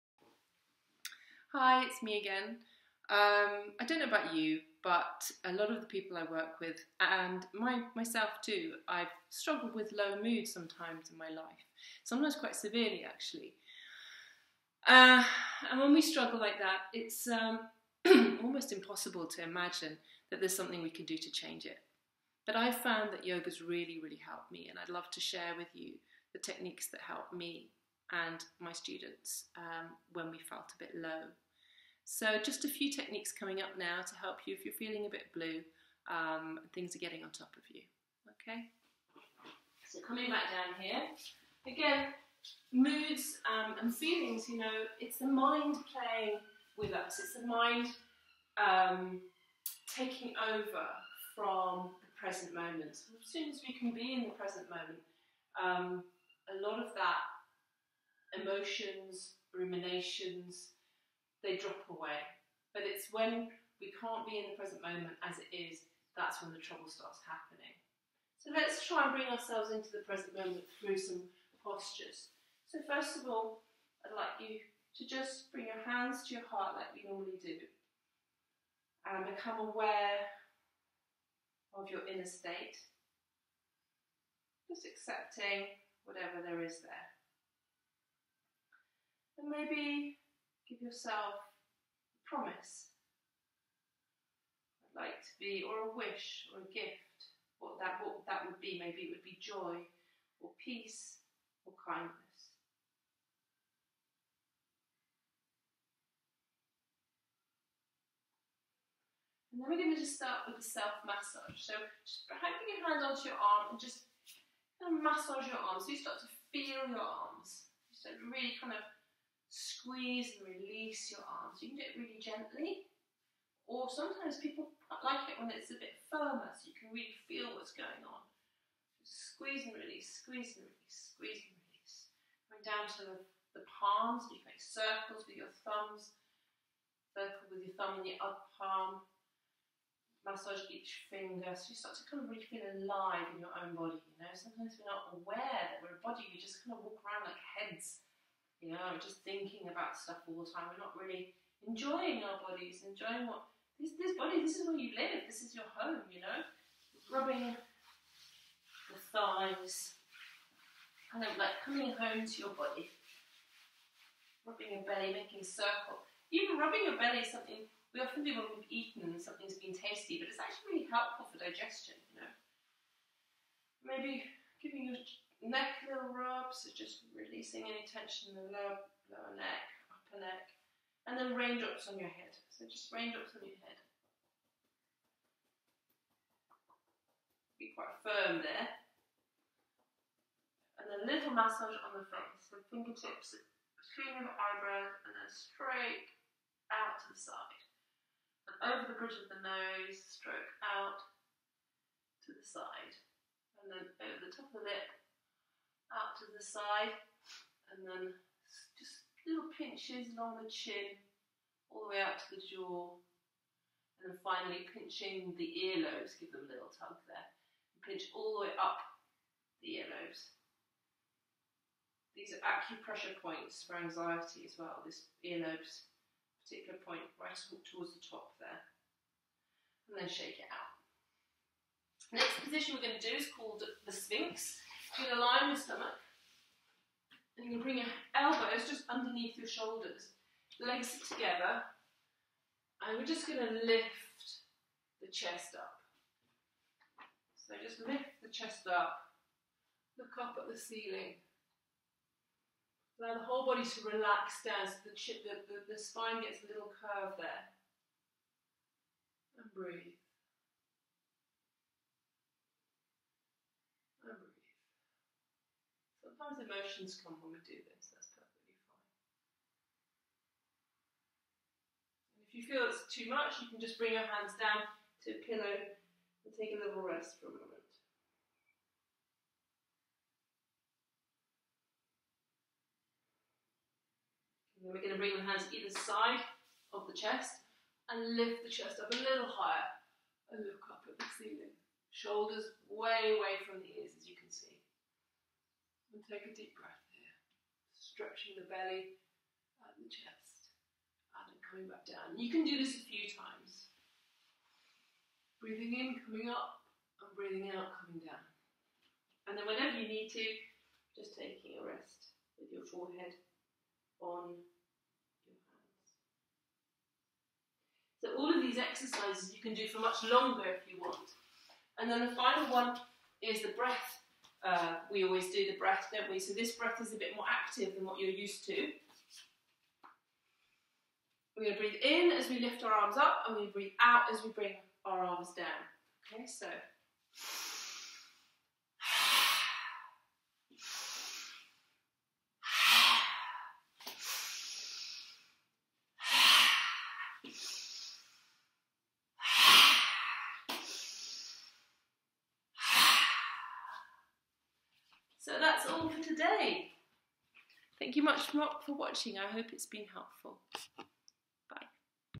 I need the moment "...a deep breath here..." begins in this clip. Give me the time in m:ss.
4:56.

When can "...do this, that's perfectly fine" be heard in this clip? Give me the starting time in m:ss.
4:27.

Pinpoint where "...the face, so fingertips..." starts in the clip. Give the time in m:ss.
3:11.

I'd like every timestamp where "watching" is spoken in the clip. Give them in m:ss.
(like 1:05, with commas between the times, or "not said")
5:58.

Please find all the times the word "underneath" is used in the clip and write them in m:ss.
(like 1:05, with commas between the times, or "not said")
3:58.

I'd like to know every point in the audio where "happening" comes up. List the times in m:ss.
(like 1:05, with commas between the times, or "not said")
1:07.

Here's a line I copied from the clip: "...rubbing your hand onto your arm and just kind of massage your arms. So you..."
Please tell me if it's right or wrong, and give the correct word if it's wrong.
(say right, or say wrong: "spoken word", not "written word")
wrong: "putting", not "rubbing".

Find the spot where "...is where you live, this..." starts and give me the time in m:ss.
2:34.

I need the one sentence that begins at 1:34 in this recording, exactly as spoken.
I'd like to be, or a wish, or a gift.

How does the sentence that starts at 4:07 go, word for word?
So just lift the chest up, look up at the ceiling.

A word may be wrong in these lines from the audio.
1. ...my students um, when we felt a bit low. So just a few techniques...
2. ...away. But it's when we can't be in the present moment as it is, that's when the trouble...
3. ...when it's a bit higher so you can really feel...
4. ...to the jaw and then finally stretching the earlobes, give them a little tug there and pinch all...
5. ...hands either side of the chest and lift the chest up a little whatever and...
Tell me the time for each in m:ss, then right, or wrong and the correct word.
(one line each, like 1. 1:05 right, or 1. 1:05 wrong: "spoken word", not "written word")
1. 0:28 right
2. 1:01 right
3. 2:05 wrong: "firmer", not "higher"
4. 3:32 wrong: "pinching", not "stretching"
5. 4:45 wrong: "higher", not "whatever".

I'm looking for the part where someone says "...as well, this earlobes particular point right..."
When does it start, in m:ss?
3:44.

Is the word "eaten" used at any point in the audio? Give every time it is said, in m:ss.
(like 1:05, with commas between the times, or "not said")
2:48.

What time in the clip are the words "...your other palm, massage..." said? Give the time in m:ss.
2:18.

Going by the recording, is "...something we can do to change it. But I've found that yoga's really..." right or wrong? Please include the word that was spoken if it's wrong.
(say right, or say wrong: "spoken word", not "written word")
right.